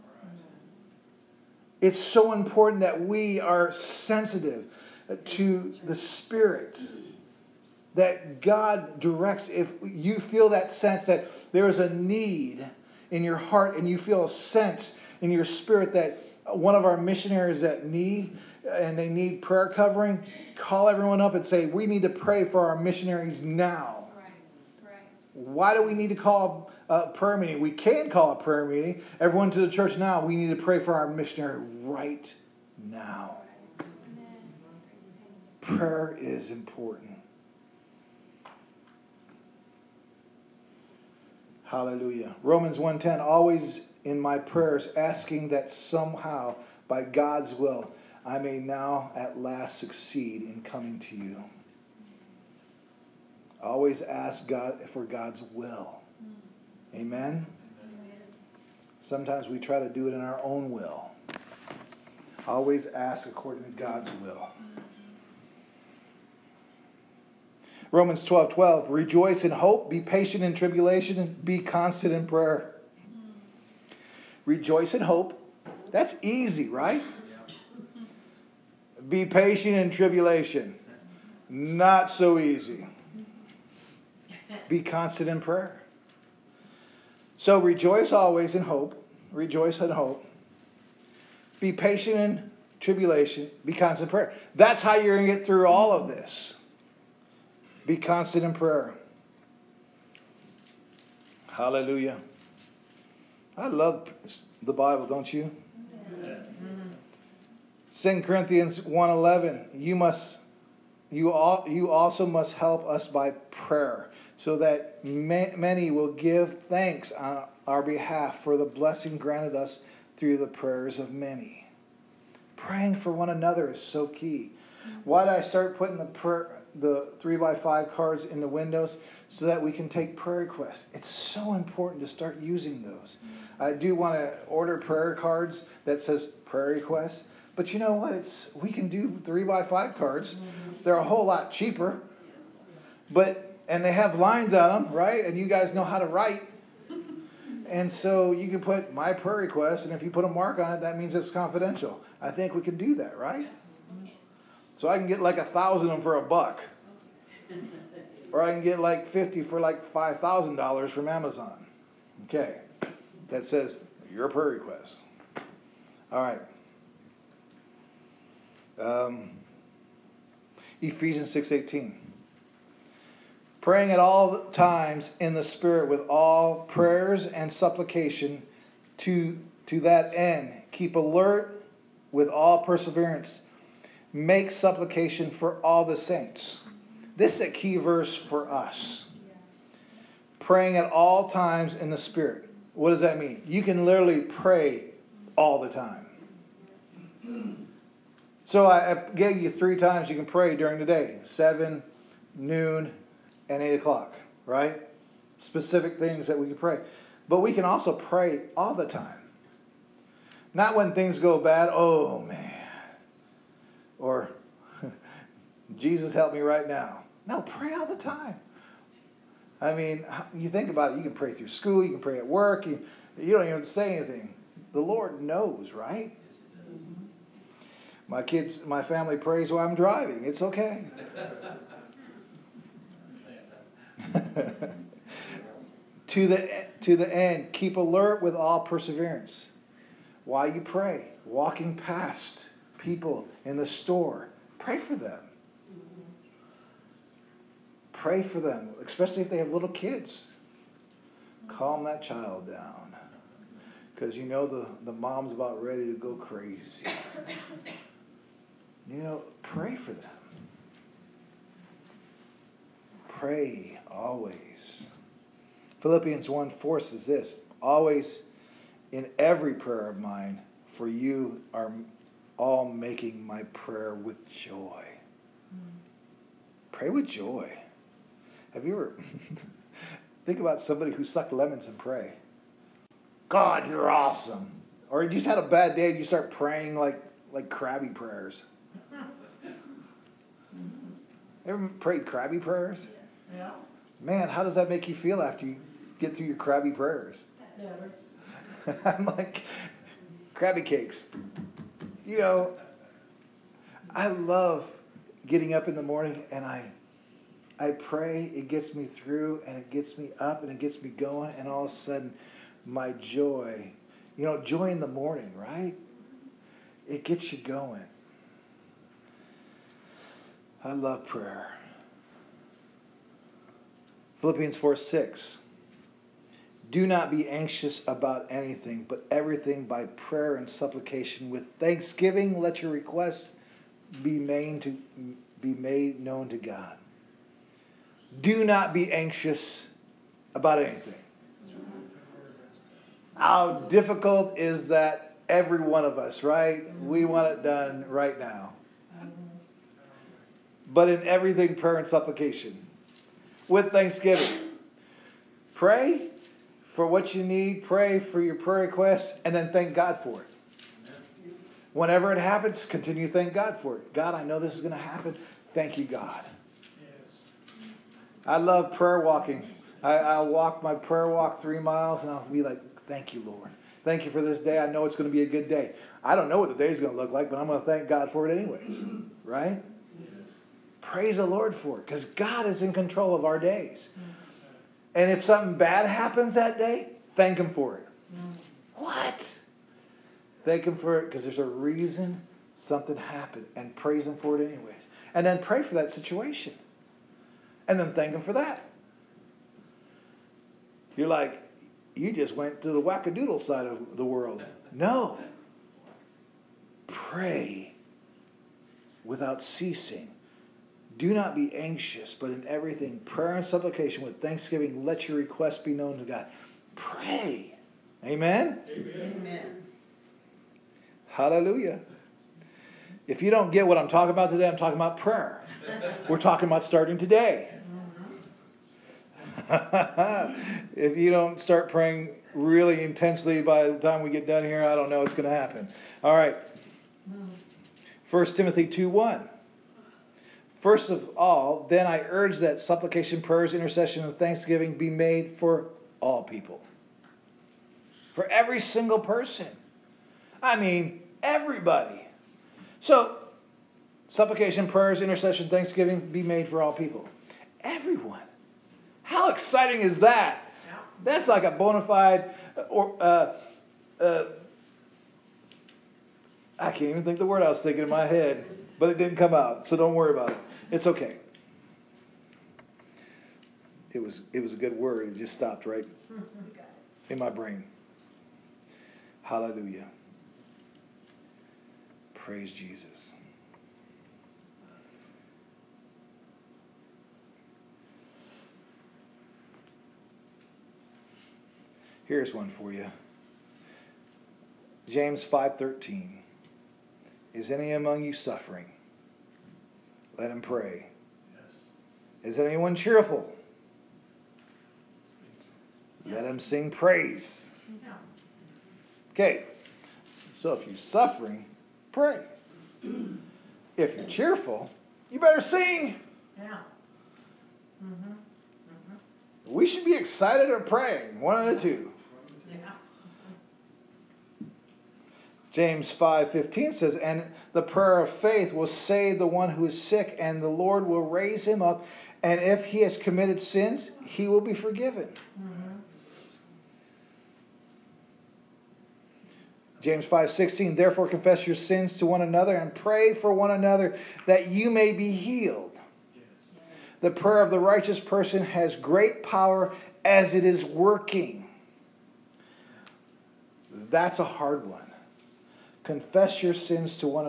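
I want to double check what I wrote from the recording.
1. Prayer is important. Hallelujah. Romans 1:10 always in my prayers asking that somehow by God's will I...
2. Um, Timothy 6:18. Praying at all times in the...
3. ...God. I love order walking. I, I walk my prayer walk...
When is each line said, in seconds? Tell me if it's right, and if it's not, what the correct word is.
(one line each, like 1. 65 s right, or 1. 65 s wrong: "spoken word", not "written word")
1. 35 s right
2. 168 s wrong: "Ephesians", not "Timothy"
3. 365 s wrong: "prayer", not "order".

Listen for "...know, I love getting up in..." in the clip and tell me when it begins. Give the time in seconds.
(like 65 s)
302 s.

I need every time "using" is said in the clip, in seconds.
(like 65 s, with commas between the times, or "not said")
132 s.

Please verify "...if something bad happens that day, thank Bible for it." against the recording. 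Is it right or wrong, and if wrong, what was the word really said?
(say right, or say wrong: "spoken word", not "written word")
wrong: "Him", not "Bible".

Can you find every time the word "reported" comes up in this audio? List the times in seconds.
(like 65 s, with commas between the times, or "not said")
not said.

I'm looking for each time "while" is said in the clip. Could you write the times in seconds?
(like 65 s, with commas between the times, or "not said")
229 s, 240 s.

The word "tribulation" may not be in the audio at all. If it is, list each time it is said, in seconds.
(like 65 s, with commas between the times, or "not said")
70 s, 79 s, 92 s.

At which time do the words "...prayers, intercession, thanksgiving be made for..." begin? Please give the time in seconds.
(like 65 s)
454 s.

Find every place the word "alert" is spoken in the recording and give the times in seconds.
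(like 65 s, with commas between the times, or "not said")
180 s, 237 s.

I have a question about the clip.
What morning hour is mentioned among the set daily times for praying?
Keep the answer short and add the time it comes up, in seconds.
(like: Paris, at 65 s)
7, at 201 s.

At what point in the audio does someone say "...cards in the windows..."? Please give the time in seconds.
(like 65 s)
127 s.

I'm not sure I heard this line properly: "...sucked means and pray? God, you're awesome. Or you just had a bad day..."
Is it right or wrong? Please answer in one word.
wrong.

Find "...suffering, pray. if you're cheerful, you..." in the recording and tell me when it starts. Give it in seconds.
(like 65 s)
510 s.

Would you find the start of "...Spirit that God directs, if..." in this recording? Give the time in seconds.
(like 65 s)
5 s.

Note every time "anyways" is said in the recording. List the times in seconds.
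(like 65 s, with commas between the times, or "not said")
378 s, 394 s.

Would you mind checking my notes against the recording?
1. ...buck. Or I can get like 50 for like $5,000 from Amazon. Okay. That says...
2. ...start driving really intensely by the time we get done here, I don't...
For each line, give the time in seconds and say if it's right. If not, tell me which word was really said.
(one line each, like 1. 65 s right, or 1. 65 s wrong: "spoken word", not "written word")
1. 156 s right
2. 431 s wrong: "praying", not "driving".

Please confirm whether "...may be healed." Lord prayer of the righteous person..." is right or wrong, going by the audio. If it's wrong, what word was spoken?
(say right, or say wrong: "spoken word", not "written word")
wrong: "The", not "Lord".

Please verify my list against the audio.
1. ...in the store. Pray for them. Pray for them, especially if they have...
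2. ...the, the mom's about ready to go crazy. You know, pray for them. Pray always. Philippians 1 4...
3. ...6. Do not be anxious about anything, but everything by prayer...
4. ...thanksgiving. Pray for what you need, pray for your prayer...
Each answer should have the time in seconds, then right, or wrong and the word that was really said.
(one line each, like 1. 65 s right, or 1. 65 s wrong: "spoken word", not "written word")
1. 243 s right
2. 254 s right
3. 324 s right
4. 353 s right.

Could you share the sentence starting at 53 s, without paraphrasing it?
Always ask God for God's will.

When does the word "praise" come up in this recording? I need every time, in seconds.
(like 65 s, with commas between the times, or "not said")
380 s, 393 s, 482 s, 506 s.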